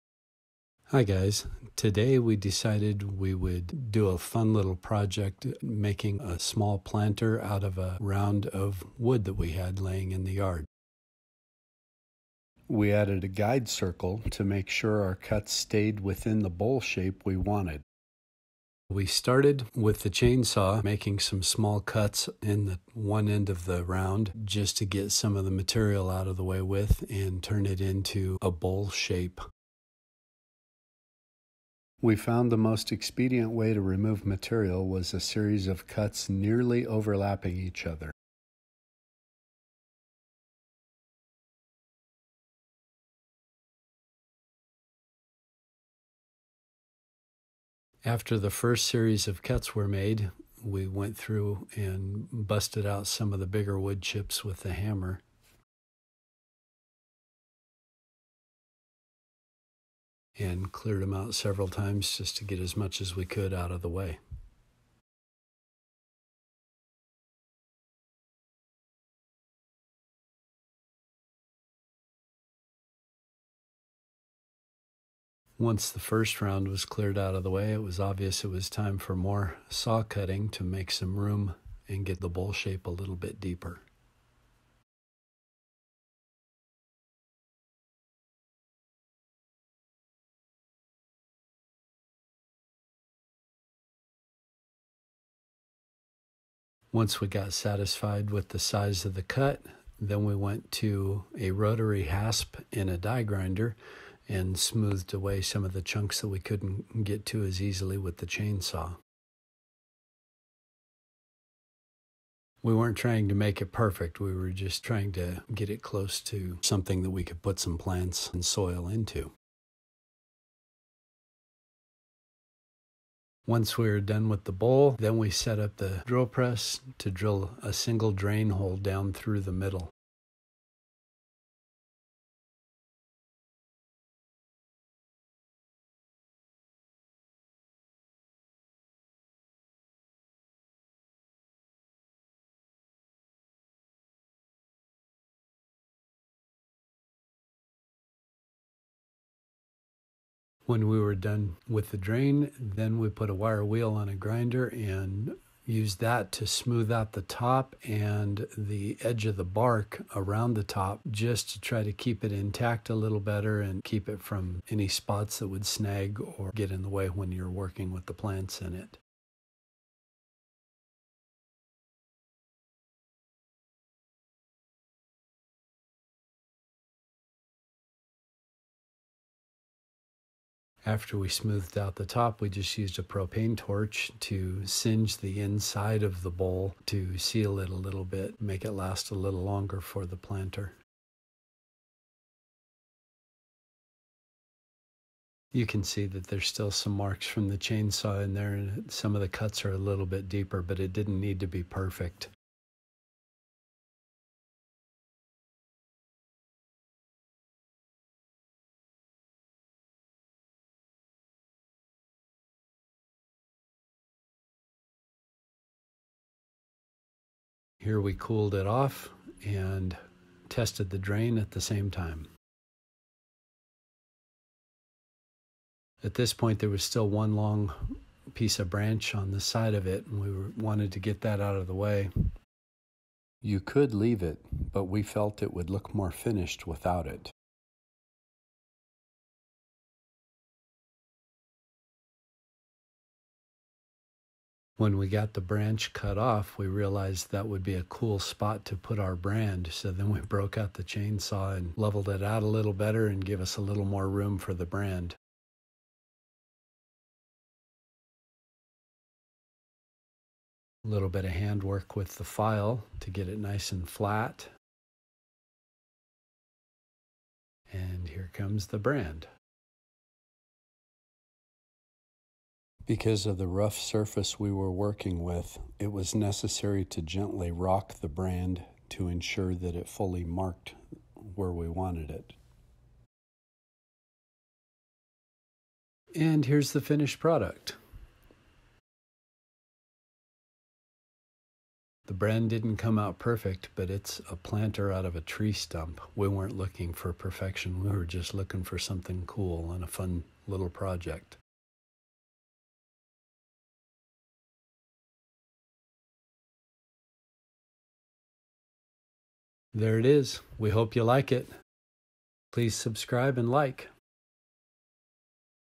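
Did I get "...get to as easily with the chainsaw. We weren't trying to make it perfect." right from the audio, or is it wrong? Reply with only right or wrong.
right.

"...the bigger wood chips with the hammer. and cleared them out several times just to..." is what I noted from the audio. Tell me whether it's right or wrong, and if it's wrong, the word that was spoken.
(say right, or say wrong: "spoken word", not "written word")
right.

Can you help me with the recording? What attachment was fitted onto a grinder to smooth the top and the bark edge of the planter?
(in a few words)
wire wheel.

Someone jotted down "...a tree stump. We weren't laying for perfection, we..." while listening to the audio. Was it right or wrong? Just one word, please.
wrong.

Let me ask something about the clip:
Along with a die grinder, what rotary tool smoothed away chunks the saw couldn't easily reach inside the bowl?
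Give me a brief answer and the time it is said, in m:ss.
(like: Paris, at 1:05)
rotary rasp, at 1:41.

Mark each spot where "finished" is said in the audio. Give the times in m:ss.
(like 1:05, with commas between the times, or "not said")
3:56, 4:46.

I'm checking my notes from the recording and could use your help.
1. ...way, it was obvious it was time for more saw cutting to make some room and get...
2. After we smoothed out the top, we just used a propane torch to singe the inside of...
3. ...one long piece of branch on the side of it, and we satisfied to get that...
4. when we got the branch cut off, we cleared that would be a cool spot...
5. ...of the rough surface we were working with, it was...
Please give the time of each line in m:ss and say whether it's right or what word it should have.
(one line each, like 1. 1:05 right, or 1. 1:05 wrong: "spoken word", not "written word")
1. 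1:17 right
2. 3:00 right
3. 3:47 wrong: "wanted", not "satisfied"
4. 4:04 wrong: "realized", not "cleared"
5. 4:33 right.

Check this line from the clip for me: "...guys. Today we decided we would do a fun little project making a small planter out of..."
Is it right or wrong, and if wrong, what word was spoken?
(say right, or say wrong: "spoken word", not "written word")
right.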